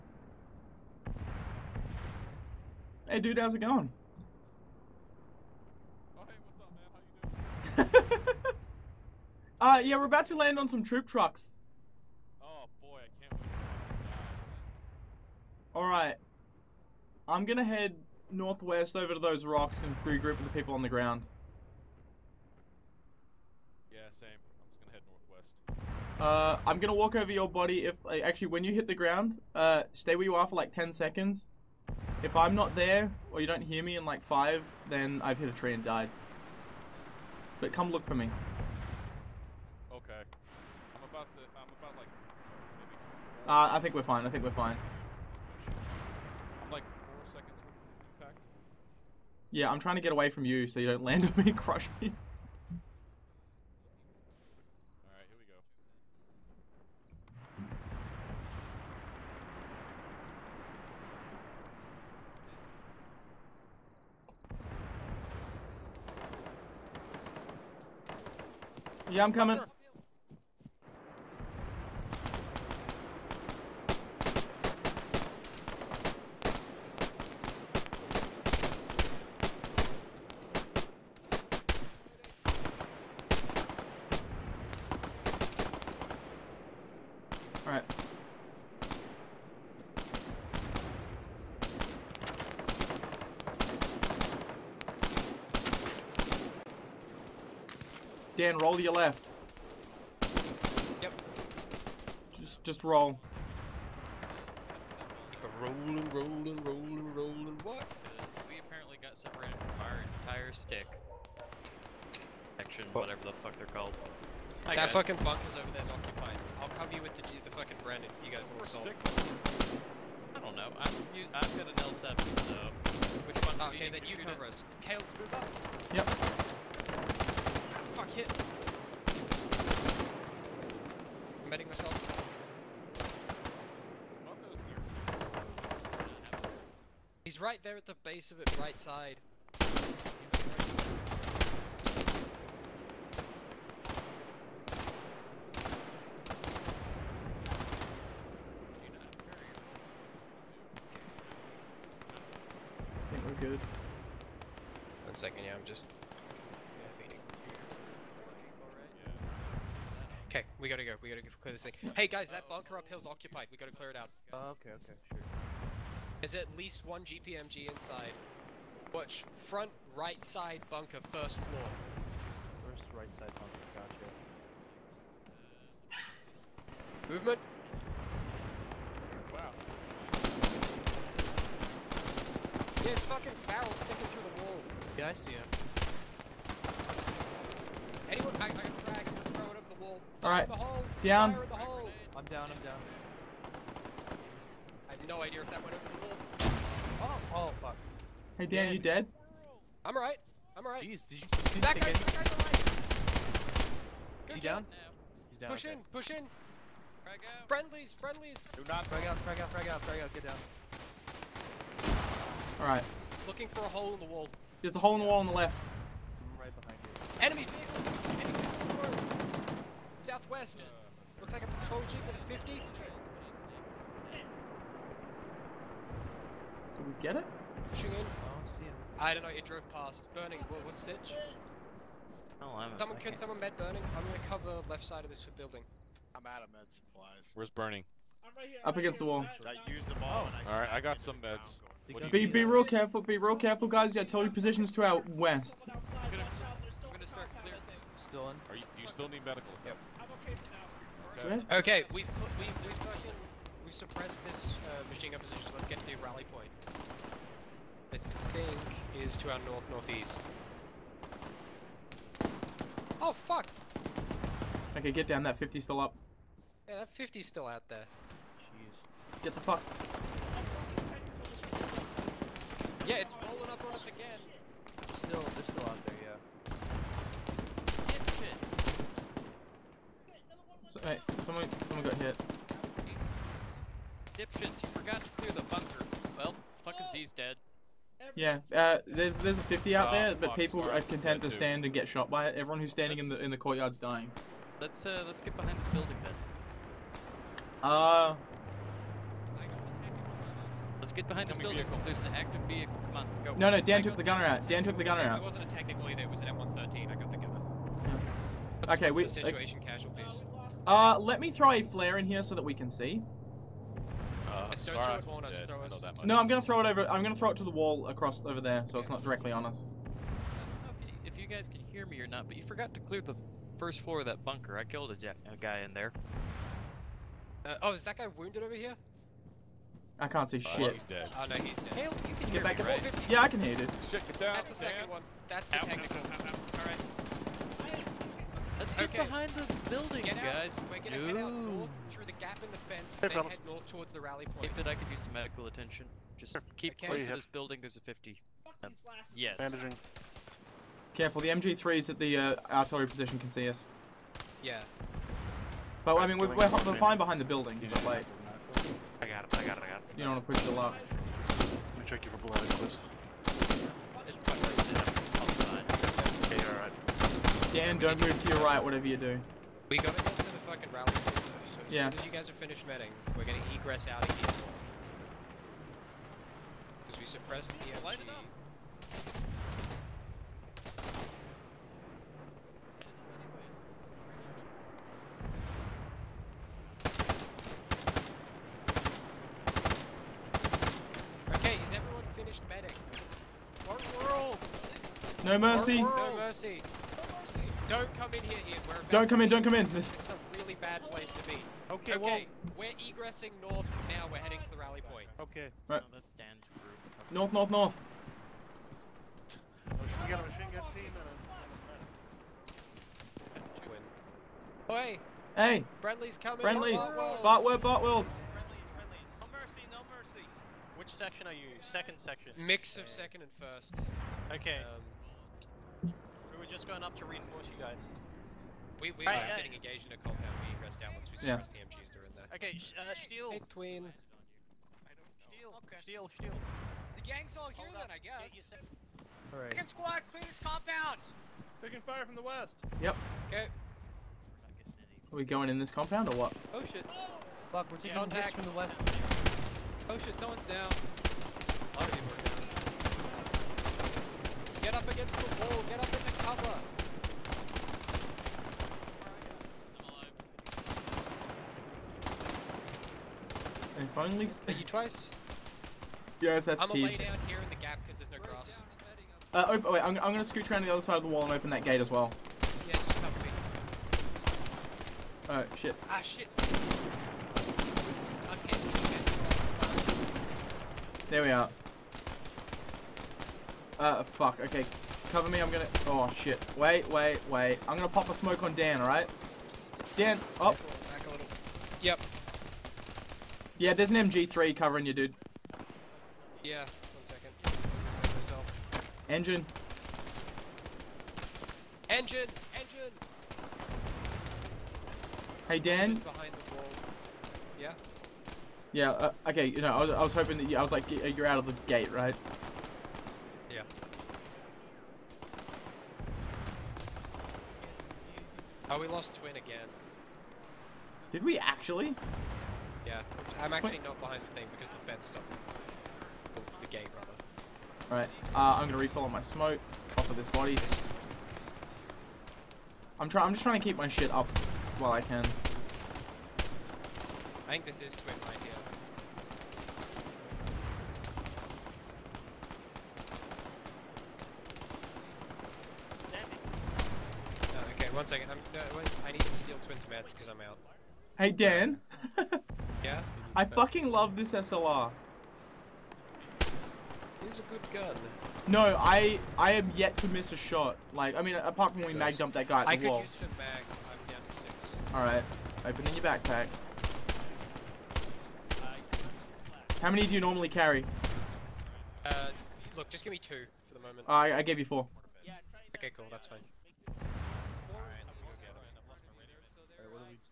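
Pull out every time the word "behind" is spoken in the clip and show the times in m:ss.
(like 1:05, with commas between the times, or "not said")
3:36, 4:55, 5:01, 5:39, 5:56, 8:25, 8:43.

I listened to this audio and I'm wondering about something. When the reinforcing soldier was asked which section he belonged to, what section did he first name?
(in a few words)
Second section.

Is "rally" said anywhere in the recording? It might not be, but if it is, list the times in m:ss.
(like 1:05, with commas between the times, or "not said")
4:16, 5:43, 6:10, 6:44.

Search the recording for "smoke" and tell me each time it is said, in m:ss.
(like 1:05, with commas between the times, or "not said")
8:08, 8:49.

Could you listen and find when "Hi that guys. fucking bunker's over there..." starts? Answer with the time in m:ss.
1:54.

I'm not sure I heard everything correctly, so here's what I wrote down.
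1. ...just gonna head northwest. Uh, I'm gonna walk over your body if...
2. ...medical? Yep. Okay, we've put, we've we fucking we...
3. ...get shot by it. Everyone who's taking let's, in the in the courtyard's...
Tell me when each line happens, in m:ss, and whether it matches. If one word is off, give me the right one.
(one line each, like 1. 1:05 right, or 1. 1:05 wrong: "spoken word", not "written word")
1. 0:24 right
2. 4:09 right
3. 4:51 wrong: "standing", not "taking".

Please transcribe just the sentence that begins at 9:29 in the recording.
How many do you normally carry?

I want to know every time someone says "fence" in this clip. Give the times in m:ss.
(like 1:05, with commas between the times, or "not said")
5:42, 8:44.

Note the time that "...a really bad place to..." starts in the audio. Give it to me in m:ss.
6:40.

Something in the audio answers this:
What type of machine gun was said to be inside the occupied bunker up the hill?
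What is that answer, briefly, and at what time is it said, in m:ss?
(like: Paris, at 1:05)
GPMG, at 2:47.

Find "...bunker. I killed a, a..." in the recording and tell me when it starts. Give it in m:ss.
5:24.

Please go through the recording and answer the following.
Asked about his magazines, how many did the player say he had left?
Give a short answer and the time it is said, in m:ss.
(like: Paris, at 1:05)
6, at 9:24.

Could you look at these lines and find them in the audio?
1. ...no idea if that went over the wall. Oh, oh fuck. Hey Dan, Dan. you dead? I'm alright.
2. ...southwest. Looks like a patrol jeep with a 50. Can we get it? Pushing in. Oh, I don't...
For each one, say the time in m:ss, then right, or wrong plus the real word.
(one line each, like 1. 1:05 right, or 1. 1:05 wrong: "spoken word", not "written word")
1. 3:15 right
2. 3:40 right.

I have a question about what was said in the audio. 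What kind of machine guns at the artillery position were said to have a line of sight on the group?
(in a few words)
MG3s.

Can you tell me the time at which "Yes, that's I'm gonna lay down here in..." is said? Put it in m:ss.
7:46.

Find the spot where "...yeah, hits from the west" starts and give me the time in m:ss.
7:27.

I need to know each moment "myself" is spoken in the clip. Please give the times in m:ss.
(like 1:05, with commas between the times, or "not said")
2:11, 8:18.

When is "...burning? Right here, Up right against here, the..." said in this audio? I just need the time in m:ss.
3:57.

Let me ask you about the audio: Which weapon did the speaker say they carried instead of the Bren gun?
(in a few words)
L7.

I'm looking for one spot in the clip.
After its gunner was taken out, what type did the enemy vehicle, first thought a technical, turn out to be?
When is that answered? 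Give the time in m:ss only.
5:06.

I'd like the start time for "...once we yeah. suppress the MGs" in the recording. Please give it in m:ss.
7:10.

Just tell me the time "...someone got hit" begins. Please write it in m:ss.
4:41.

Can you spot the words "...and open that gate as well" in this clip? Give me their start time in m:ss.
7:51.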